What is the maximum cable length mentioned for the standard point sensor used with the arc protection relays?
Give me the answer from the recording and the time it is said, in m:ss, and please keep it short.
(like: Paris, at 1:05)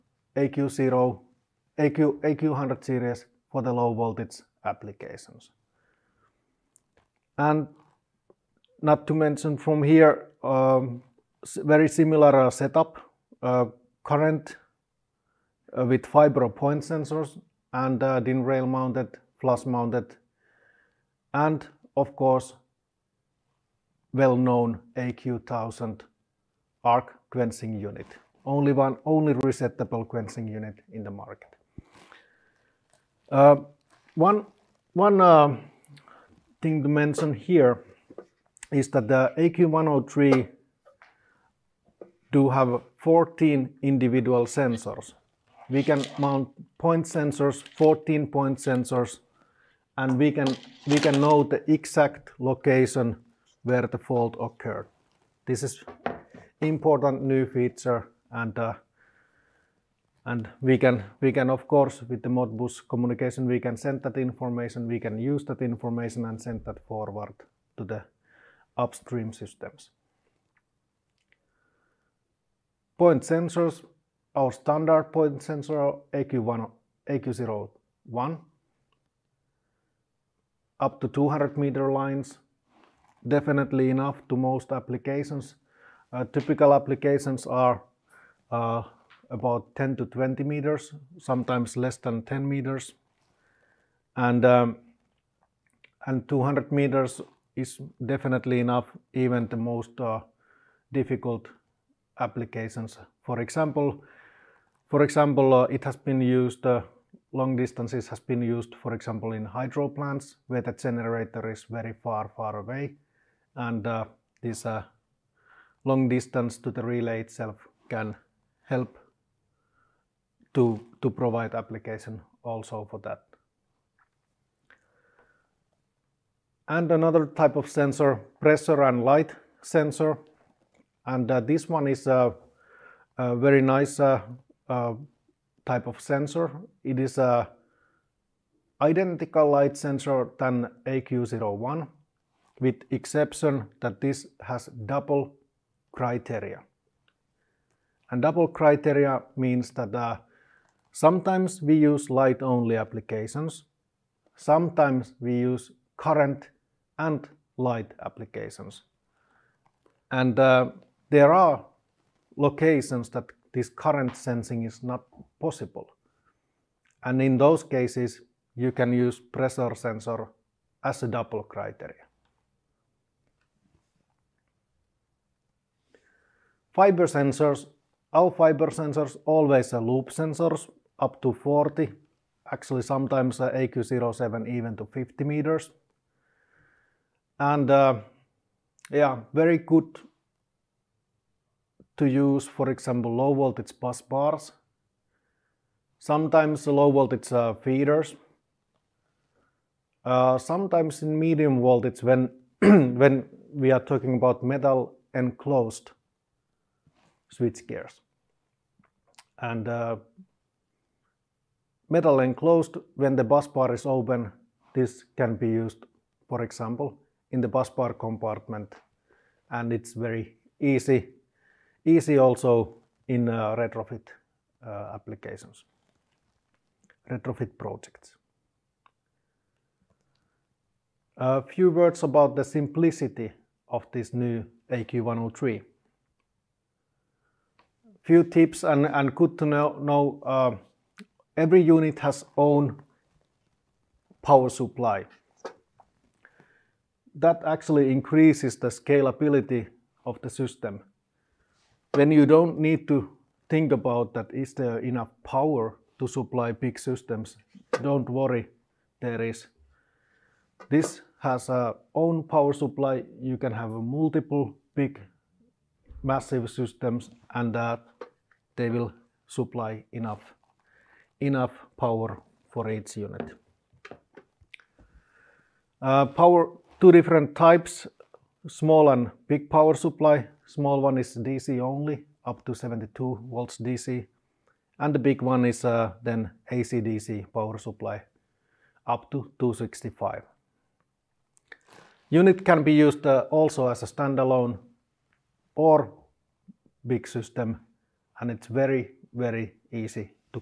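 200 meters, at 1:21.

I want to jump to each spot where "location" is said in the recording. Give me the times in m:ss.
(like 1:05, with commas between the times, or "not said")
0:52, 2:42.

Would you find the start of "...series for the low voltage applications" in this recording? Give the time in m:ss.
0:02.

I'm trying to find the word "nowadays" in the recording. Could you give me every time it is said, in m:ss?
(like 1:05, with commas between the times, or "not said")
not said.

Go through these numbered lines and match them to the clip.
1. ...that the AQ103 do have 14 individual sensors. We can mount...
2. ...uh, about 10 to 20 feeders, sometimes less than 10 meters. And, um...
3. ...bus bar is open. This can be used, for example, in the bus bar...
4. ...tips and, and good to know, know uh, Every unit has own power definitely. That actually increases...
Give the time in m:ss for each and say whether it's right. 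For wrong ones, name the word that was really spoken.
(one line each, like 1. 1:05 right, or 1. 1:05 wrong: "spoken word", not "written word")
1. 0:38 right
2. 1:28 wrong: "meters", not "feeders"
3. 3:33 right
4. 3:58 wrong: "supply", not "definitely".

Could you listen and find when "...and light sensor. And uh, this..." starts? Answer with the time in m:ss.
2:08.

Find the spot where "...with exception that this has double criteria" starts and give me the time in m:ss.
2:22.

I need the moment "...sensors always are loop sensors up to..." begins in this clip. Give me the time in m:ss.
2:58.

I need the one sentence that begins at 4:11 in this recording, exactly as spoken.
When you don't need to think about that is there enough power to supply big systems.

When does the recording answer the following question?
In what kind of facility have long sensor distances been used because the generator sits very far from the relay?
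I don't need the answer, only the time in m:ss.
1:49.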